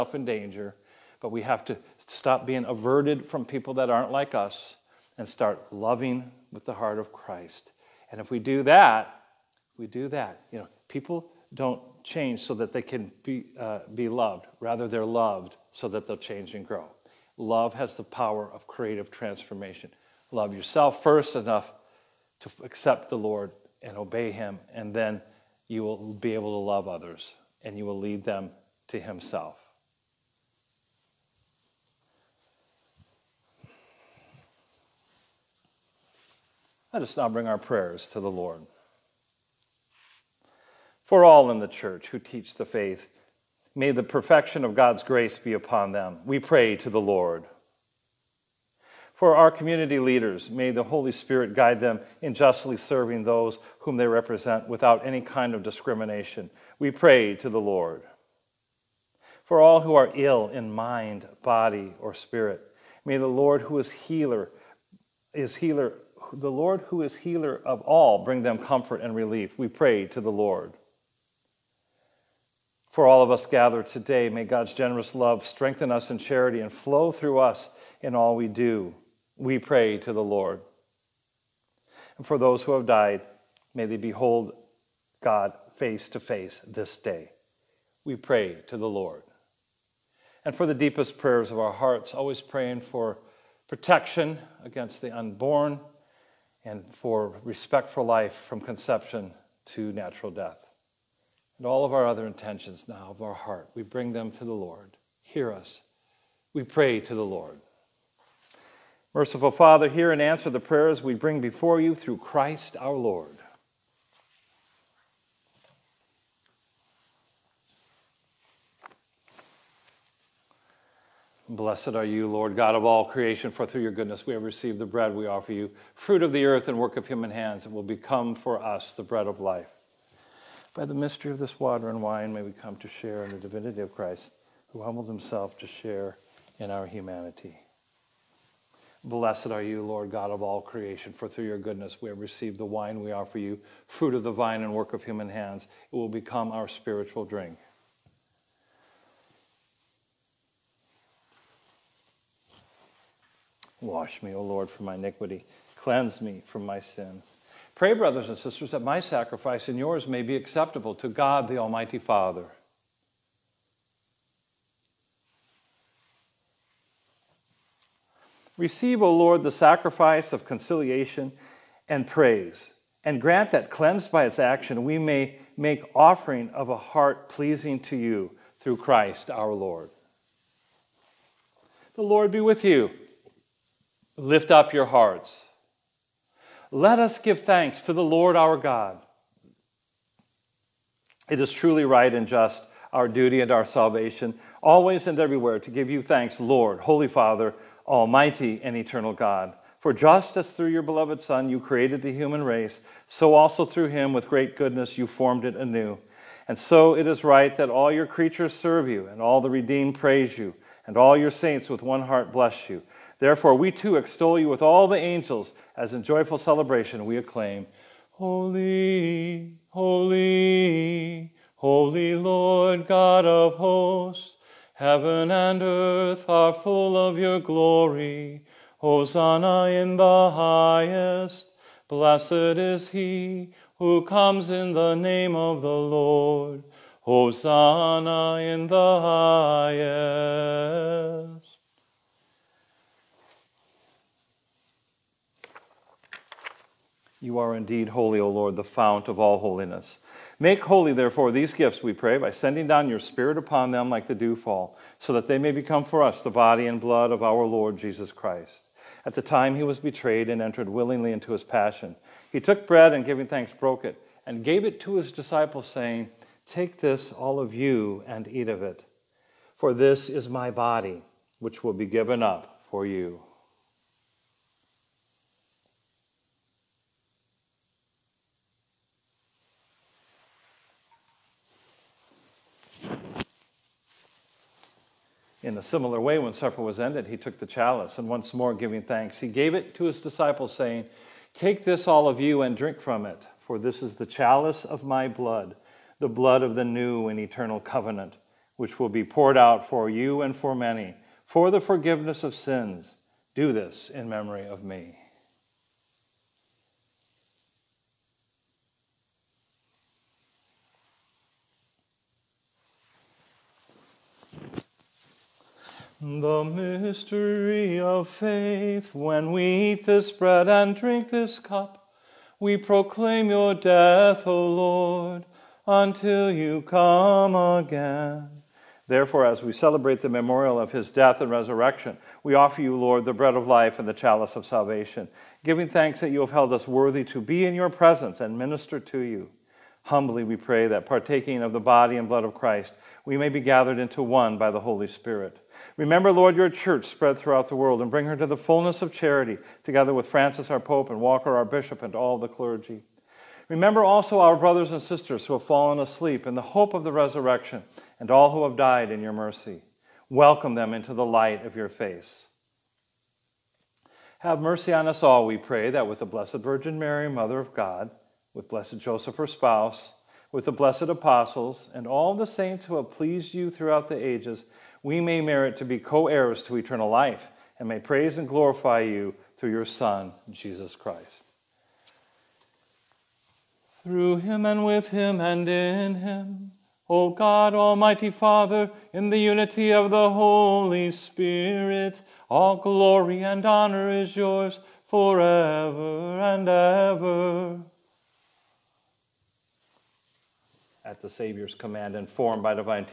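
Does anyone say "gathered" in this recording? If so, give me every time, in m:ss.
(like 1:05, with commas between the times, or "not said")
1:13, 5:43.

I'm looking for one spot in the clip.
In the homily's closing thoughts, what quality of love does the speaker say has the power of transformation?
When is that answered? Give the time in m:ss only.
0:18.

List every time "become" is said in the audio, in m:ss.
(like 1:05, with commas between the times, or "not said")
2:07, 2:26, 4:15.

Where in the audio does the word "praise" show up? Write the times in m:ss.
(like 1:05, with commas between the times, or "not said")
2:52, 3:29, 6:17.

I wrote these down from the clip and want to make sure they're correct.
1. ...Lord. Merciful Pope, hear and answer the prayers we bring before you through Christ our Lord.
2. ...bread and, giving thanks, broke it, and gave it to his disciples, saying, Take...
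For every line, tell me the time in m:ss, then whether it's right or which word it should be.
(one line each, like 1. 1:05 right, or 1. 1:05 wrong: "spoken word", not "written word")
1. 1:47 wrong: "Father", not "Pope"
2. 4:22 right.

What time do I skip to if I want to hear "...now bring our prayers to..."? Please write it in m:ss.
0:37.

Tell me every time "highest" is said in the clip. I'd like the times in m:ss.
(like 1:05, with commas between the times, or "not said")
3:50, 3:58.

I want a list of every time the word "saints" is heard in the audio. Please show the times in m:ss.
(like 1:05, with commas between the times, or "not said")
3:31, 6:12.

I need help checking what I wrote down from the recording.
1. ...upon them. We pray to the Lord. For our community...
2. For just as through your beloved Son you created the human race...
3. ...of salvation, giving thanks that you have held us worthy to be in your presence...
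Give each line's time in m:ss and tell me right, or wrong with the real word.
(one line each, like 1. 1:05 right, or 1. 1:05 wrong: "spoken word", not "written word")
1. 0:45 right
2. 3:19 right
3. 5:34 right.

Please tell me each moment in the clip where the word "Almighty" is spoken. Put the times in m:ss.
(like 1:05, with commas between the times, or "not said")
2:41, 3:17, 6:27.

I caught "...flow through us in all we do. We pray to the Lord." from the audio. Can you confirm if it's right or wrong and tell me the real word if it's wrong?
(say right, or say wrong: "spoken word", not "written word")
right.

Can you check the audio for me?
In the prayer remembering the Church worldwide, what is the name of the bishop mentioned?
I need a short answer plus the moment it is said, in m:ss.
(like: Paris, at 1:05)
Walker, at 5:50.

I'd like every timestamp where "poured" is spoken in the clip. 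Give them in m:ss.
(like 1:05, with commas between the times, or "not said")
4:59.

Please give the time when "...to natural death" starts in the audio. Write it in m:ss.
1:39.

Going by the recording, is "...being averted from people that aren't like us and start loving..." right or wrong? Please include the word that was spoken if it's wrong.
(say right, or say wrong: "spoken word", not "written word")
right.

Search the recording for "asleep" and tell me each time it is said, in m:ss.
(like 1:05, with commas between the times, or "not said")
5:55.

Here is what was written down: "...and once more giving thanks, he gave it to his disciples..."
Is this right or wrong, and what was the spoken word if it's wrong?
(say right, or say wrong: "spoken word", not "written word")
right.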